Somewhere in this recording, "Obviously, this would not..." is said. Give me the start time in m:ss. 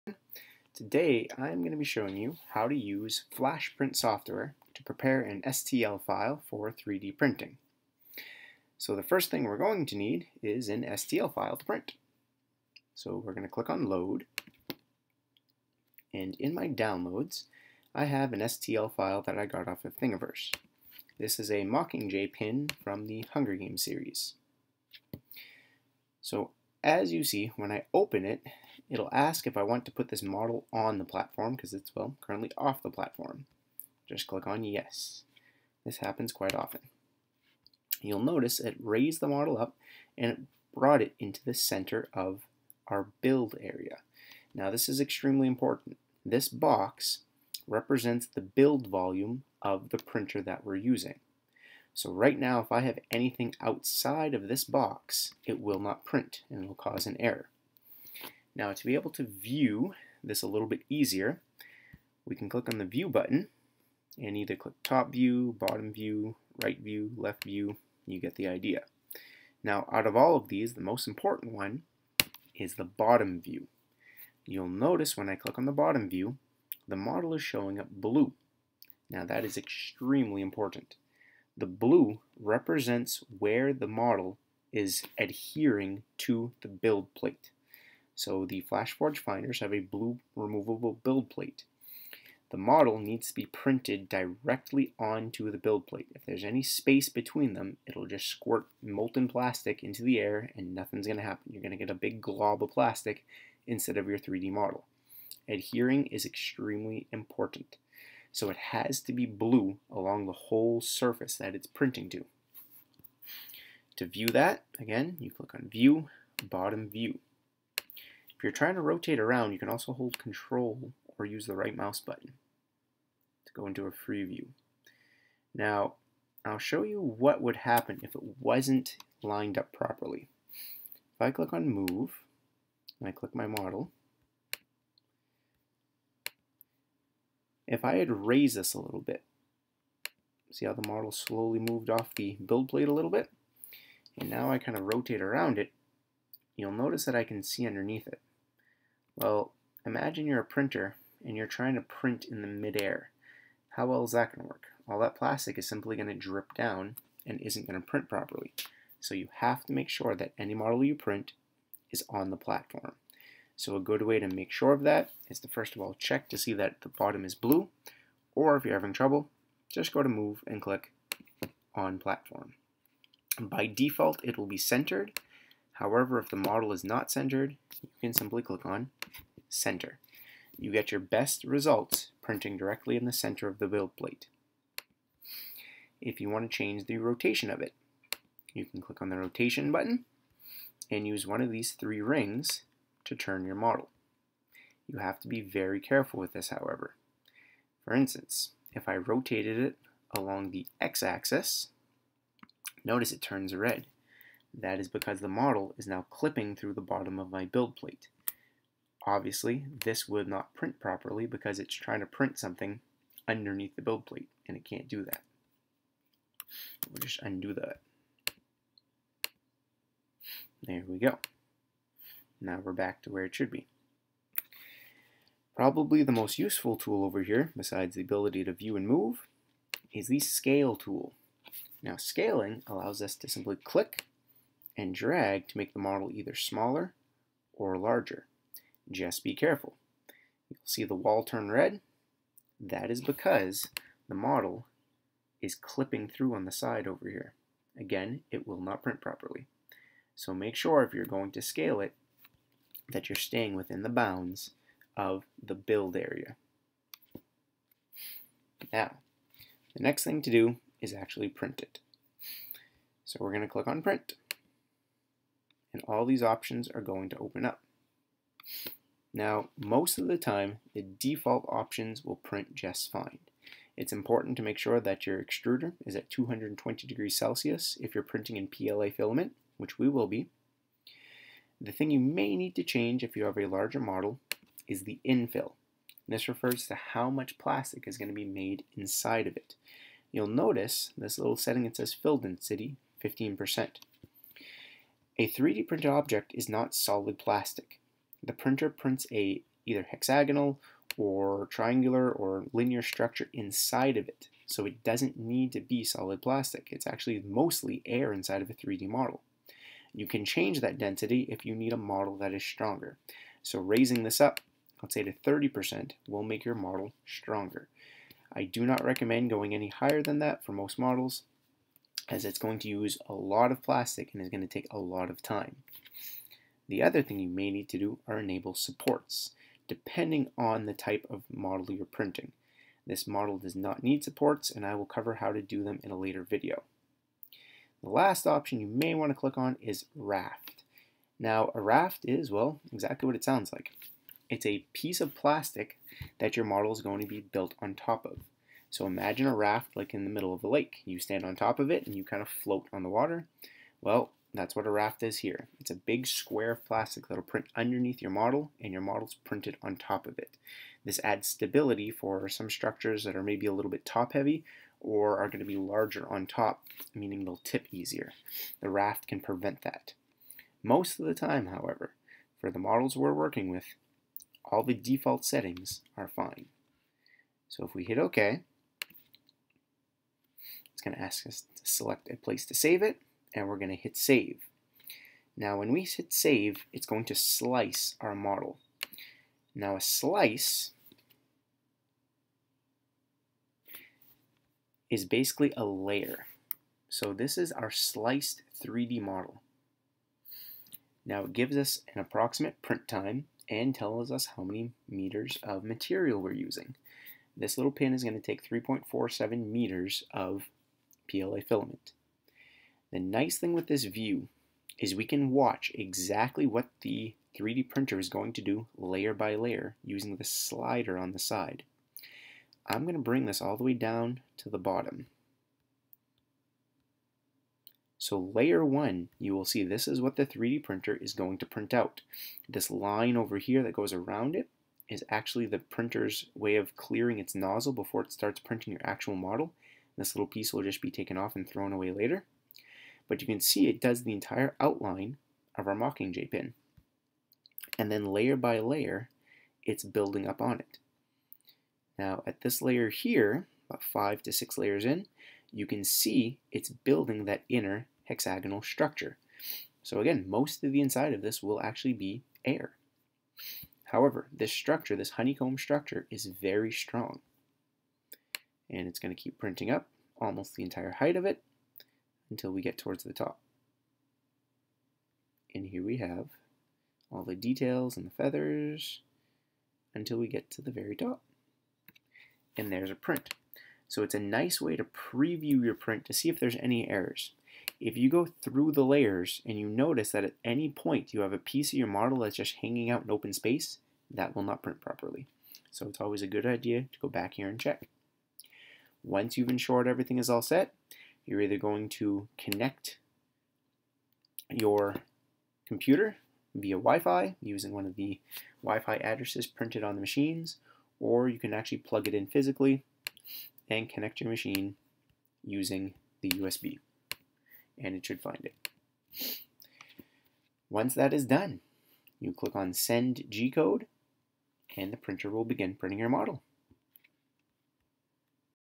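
3:29.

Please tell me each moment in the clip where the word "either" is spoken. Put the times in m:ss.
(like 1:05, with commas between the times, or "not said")
1:04, 3:56, 4:59, 8:21.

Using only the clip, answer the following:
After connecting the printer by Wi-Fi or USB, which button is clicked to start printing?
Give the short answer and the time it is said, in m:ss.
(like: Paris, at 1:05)
Send G-Code, at 8:42.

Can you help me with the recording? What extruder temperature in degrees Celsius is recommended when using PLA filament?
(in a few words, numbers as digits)
220.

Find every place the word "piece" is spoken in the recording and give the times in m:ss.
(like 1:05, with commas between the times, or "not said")
5:44, 7:20, 8:11.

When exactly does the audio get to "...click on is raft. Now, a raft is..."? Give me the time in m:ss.
5:39.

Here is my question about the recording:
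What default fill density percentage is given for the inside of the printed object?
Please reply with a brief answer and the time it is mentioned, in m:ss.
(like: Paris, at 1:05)
15%, at 4:53.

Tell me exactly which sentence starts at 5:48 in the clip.
So imagine a raft like in the middle of a lake.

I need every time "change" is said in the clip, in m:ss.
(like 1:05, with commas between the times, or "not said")
3:06, 4:42, 5:10.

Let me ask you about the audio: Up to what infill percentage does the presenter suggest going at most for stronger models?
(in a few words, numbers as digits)
30%.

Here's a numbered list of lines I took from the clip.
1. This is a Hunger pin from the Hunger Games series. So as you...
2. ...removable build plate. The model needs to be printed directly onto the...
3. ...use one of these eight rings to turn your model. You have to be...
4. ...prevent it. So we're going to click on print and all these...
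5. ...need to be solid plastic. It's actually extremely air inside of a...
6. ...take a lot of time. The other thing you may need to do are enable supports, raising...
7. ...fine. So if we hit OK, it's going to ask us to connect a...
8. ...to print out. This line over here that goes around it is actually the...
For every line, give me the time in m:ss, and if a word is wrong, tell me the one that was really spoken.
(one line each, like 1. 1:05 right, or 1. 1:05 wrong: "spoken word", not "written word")
1. 0:21 wrong: "Mockingjay", not "Hunger"
2. 1:30 right
3. 3:11 wrong: "three", not "eight"
4. 4:21 wrong: "print", not "prevent"
5. 5:05 wrong: "mostly", not "extremely"
6. 5:24 wrong: "depending", not "raising"
7. 6:16 wrong: "select", not "connect"
8. 7:11 right.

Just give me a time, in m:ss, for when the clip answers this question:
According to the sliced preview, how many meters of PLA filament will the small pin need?
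6:48.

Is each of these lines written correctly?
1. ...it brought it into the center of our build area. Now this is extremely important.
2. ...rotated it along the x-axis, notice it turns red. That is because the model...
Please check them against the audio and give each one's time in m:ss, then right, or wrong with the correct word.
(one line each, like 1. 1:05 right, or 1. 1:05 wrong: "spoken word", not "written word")
1. 0:40 right
2. 3:18 right.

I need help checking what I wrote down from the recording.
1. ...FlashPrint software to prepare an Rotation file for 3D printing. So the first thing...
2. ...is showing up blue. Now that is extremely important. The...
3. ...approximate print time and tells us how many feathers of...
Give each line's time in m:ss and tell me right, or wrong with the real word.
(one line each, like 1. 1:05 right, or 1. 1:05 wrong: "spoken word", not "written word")
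1. 0:03 wrong: "STL", not "Rotation"
2. 1:17 right
3. 6:42 wrong: "meters", not "feathers".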